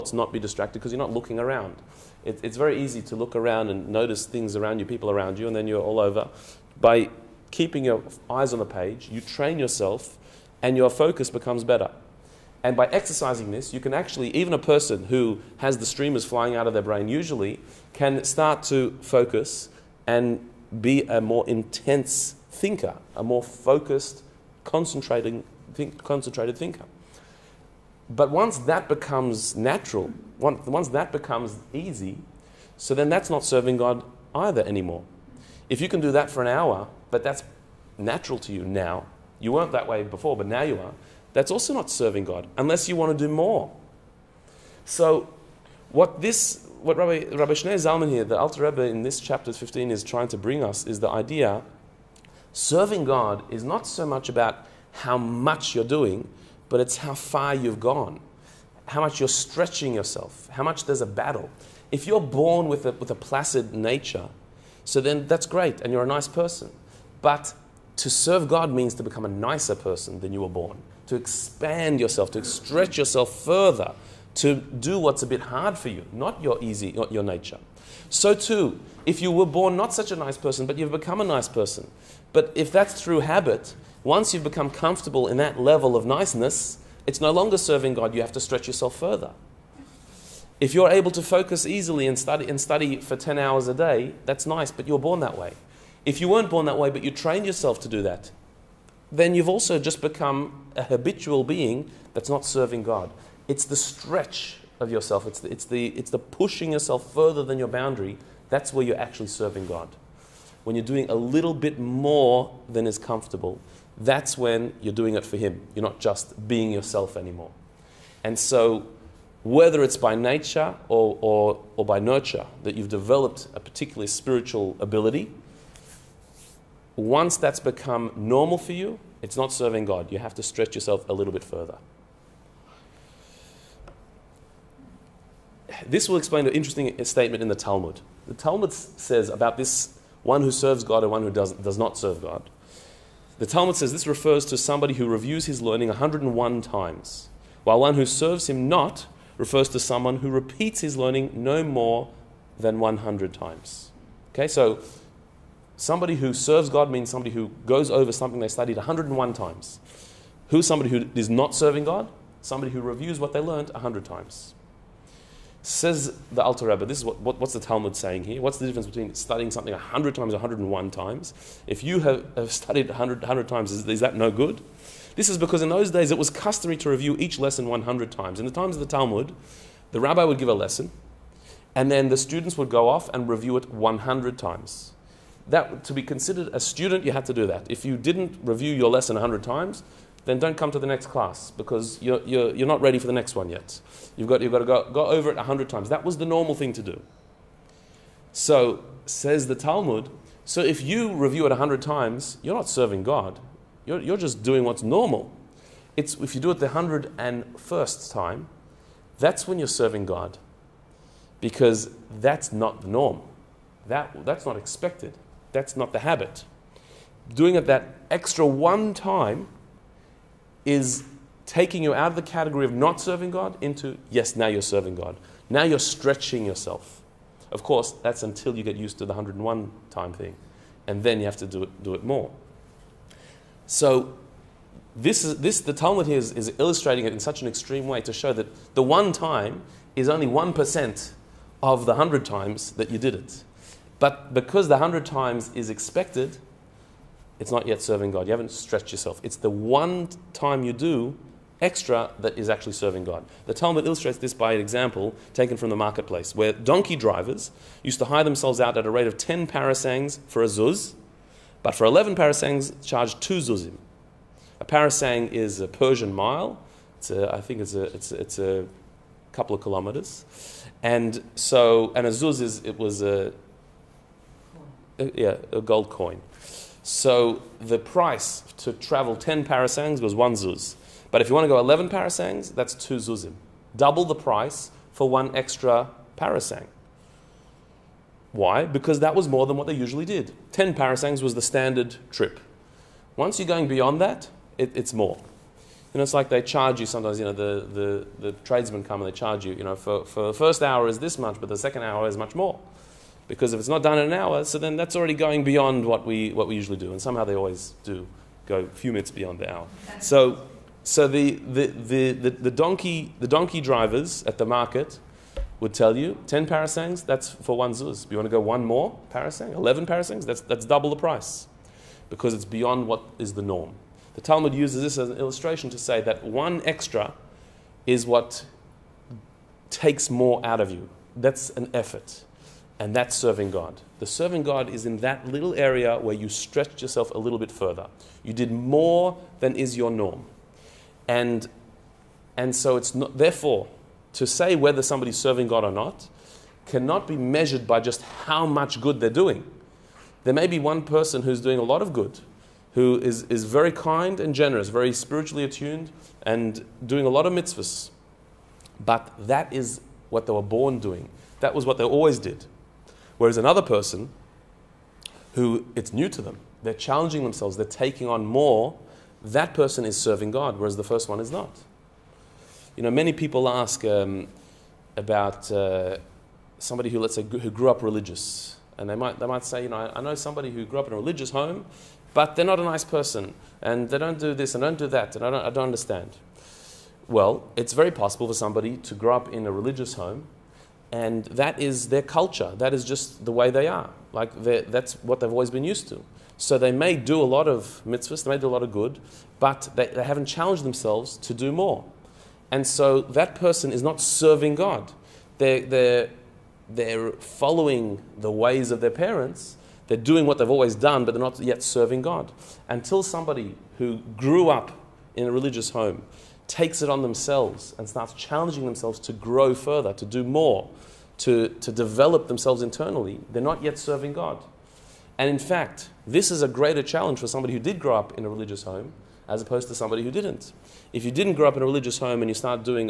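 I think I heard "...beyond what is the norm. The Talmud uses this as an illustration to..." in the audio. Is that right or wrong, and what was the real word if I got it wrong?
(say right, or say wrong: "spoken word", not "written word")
right.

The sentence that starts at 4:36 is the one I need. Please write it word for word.
So the price to travel 10 parasangs was one zuz.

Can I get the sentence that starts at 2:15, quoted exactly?
This will explain an interesting statement in the Talmud.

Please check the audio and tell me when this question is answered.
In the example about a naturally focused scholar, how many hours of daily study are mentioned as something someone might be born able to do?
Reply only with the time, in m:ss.
1:33.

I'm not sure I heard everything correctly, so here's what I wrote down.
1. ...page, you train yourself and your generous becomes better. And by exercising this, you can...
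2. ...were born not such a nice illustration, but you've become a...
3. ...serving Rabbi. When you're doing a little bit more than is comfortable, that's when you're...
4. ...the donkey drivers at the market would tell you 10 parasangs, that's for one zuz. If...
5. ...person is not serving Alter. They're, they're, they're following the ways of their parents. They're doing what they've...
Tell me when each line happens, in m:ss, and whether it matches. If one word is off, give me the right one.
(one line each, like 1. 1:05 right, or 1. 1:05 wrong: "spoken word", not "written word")
1. 0:08 wrong: "focus", not "generous"
2. 1:19 wrong: "person", not "illustration"
3. 1:49 wrong: "God", not "Rabbi"
4. 5:13 right
5. 6:43 wrong: "God", not "Alter".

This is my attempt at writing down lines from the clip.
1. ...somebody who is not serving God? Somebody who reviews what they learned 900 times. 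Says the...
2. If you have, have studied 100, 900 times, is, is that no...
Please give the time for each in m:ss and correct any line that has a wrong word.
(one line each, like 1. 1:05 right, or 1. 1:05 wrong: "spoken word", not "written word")
1. 2:40 wrong: "100", not "900"
2. 2:51 wrong: "100", not "900".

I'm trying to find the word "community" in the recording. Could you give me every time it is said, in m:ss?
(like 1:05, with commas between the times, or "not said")
not said.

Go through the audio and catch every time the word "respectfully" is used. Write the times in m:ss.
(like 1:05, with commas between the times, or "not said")
not said.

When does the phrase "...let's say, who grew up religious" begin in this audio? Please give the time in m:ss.
6:16.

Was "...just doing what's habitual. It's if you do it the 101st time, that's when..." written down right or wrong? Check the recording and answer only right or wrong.
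wrong.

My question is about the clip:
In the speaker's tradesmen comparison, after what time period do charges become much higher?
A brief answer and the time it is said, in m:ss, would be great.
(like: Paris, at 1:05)
First hour, at 5:00.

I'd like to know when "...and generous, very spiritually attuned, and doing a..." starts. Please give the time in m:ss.
5:54.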